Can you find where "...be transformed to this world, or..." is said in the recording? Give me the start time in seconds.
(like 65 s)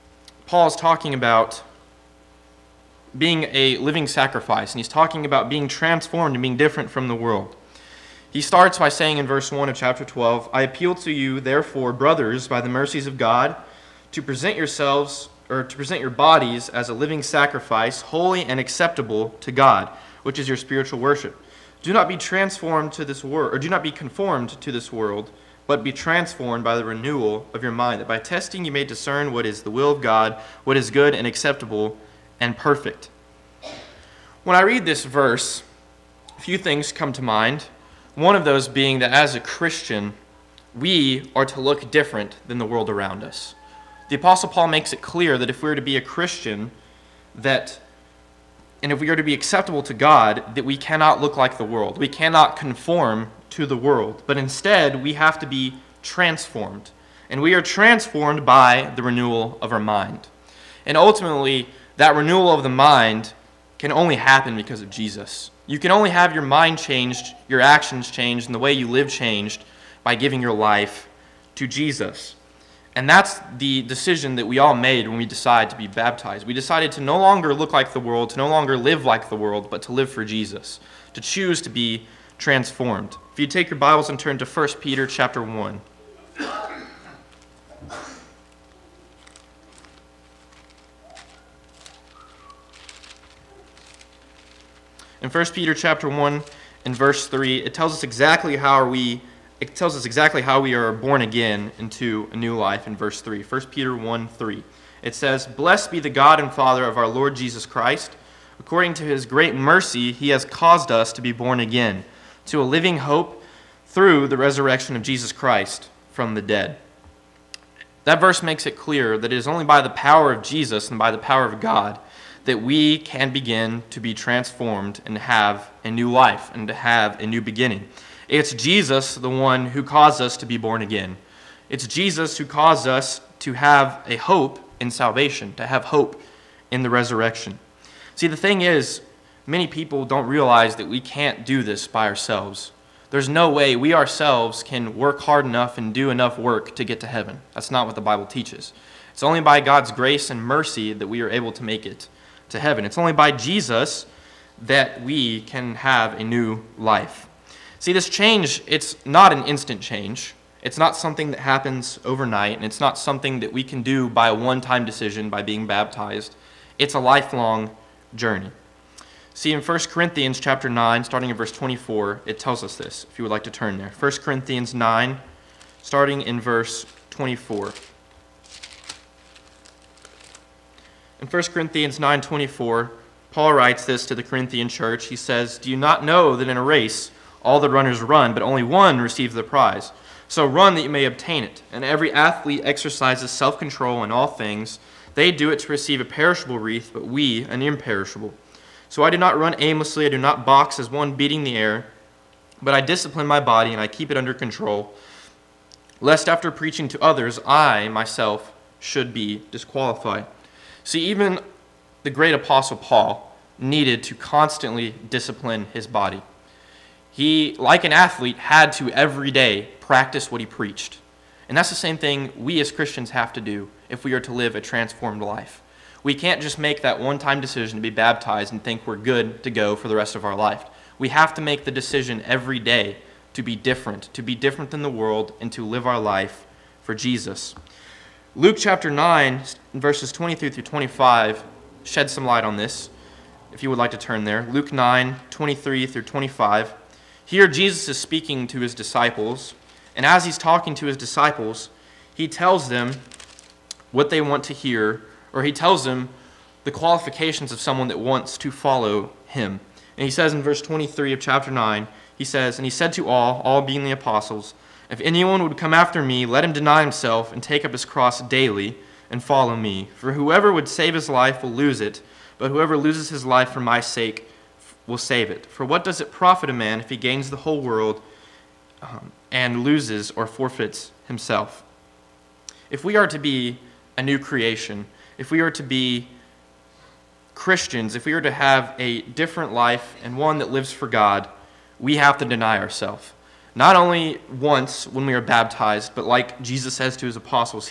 22 s.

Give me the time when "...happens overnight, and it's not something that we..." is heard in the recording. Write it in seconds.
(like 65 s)
161 s.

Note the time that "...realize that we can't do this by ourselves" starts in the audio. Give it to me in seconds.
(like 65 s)
140 s.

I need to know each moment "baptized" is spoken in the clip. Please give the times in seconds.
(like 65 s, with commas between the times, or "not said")
75 s, 165 s, 227 s, 295 s.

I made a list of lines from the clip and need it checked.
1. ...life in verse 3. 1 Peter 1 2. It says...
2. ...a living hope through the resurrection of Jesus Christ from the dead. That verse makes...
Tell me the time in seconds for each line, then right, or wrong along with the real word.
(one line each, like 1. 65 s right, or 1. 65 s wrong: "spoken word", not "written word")
1. 102 s wrong: "3", not "2"
2. 112 s right.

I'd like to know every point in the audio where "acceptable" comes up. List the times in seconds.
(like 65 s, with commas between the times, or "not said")
18 s, 31 s, 49 s.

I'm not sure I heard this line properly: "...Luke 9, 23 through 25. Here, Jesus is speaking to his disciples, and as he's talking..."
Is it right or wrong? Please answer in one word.
right.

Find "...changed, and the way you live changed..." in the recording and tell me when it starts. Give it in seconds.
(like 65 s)
68 s.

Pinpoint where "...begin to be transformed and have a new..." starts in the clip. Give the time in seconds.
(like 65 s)
123 s.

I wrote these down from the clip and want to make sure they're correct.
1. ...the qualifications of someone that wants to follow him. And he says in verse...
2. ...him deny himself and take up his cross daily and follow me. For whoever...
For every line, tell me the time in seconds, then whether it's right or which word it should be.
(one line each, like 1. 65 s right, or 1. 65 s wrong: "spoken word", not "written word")
1. 256 s right
2. 266 s right.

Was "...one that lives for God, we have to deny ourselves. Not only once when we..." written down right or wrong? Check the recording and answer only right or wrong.
right.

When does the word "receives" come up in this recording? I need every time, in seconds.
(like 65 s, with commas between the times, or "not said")
189 s, 195 s.